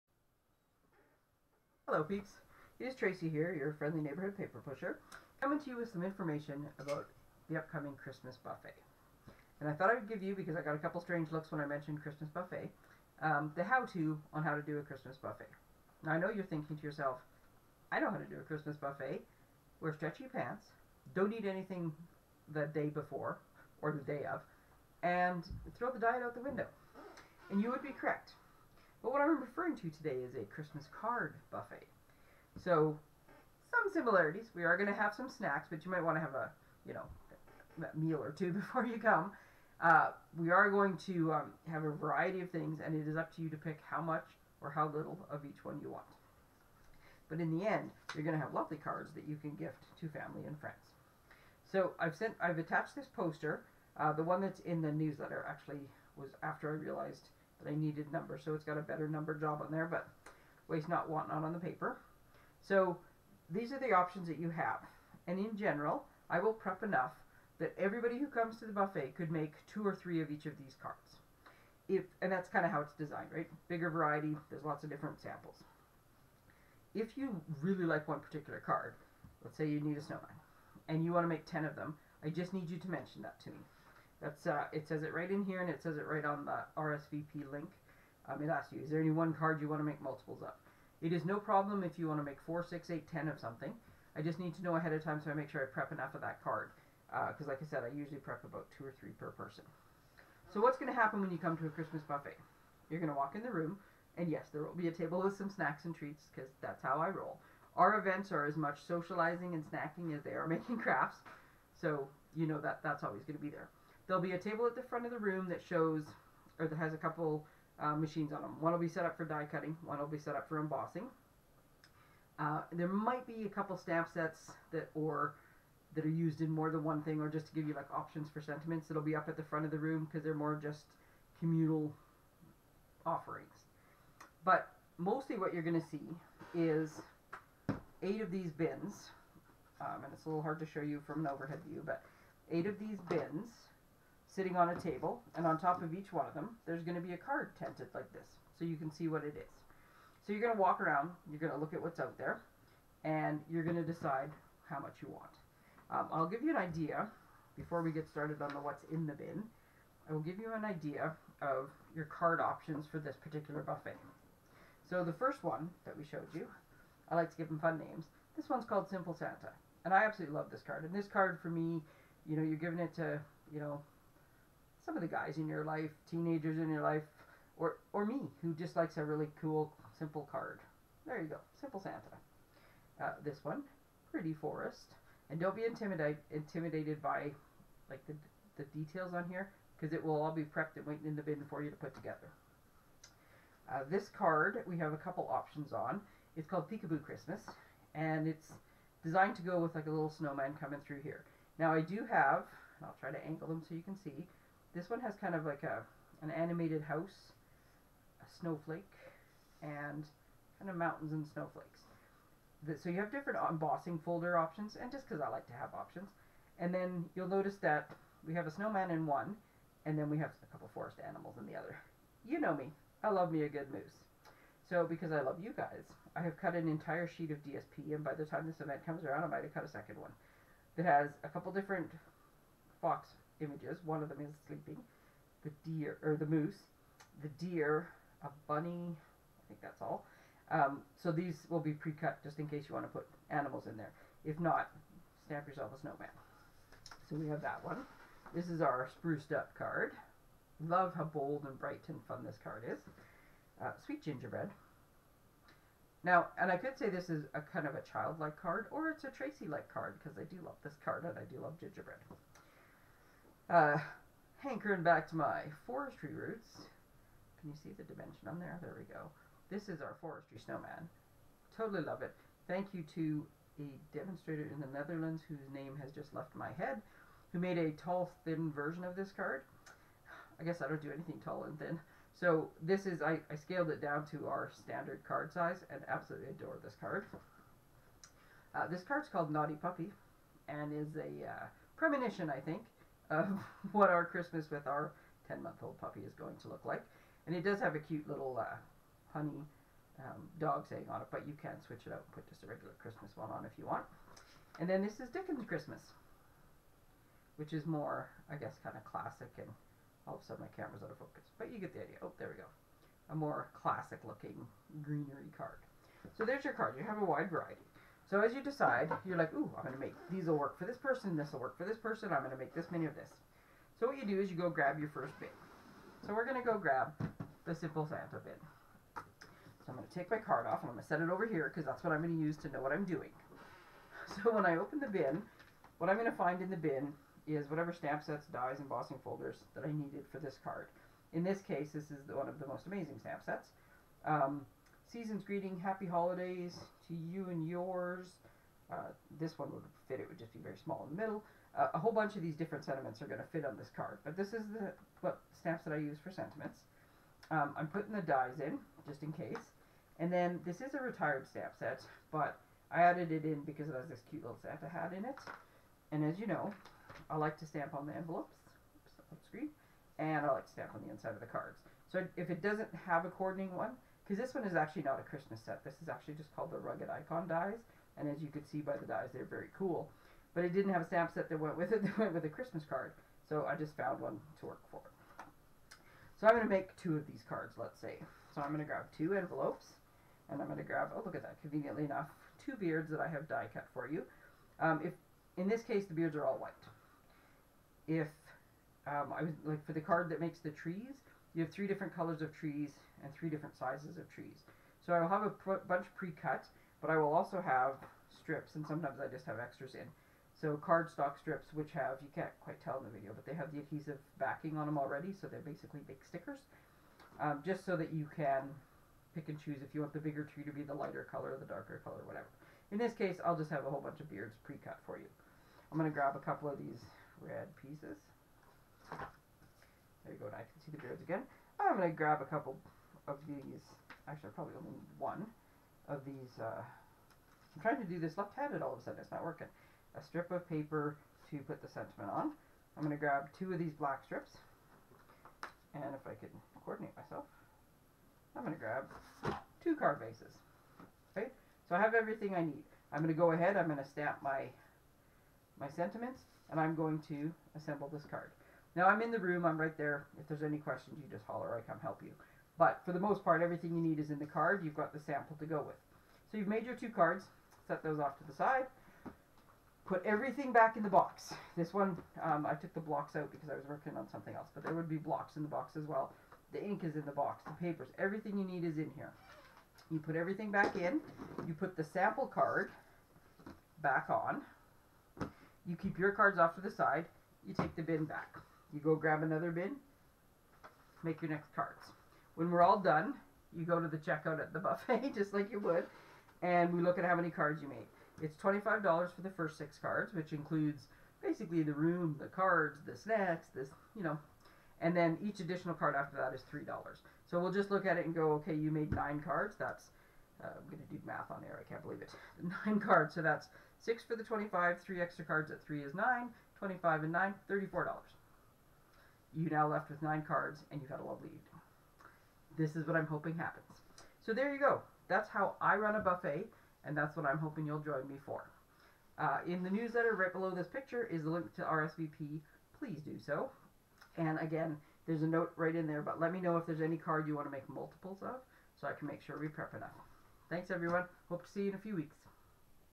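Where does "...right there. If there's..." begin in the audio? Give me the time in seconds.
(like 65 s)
459 s.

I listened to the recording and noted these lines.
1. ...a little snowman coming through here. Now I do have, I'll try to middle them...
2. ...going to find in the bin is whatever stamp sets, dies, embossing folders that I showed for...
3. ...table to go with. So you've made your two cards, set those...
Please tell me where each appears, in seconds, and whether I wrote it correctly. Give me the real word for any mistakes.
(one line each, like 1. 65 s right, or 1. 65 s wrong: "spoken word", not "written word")
1. 199 s wrong: "angle", not "middle"
2. 335 s wrong: "needed", not "showed"
3. 464 s wrong: "sample", not "table".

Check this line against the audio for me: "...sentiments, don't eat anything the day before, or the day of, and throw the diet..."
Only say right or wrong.
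wrong.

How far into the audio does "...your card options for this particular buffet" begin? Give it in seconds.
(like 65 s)
161 s.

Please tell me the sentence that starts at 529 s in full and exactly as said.
Uh, in the newsletter right below this picture is the link to RSVP.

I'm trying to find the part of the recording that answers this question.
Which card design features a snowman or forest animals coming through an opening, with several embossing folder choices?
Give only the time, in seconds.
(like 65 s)
196 s.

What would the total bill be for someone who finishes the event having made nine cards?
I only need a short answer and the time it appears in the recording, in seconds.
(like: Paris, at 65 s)
$34, at 517 s.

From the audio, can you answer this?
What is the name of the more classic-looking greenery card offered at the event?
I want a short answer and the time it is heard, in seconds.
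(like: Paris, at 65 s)
Dickens Christmas, at 305 s.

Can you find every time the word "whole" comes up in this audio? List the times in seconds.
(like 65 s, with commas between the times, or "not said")
351 s, 423 s.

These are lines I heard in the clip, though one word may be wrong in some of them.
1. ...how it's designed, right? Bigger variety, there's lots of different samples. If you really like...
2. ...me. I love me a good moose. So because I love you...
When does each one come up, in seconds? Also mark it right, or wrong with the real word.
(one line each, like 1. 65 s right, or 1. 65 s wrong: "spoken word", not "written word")
1. 72 s right
2. 222 s right.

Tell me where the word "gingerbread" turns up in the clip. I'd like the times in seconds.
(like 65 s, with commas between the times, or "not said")
254 s, 261 s.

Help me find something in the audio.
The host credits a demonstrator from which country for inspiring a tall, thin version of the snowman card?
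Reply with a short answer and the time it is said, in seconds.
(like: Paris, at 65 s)
Netherlands, at 274 s.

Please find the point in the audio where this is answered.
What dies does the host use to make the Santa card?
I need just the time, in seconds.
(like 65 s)
376 s.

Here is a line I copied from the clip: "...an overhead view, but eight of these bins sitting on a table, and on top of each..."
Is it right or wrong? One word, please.
right.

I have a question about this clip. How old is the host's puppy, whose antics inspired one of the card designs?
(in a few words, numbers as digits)
10 months.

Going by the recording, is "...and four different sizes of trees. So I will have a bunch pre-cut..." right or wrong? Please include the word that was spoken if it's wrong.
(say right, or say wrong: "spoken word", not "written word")
wrong: "three", not "four".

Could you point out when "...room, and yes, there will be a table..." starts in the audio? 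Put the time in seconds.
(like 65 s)
103 s.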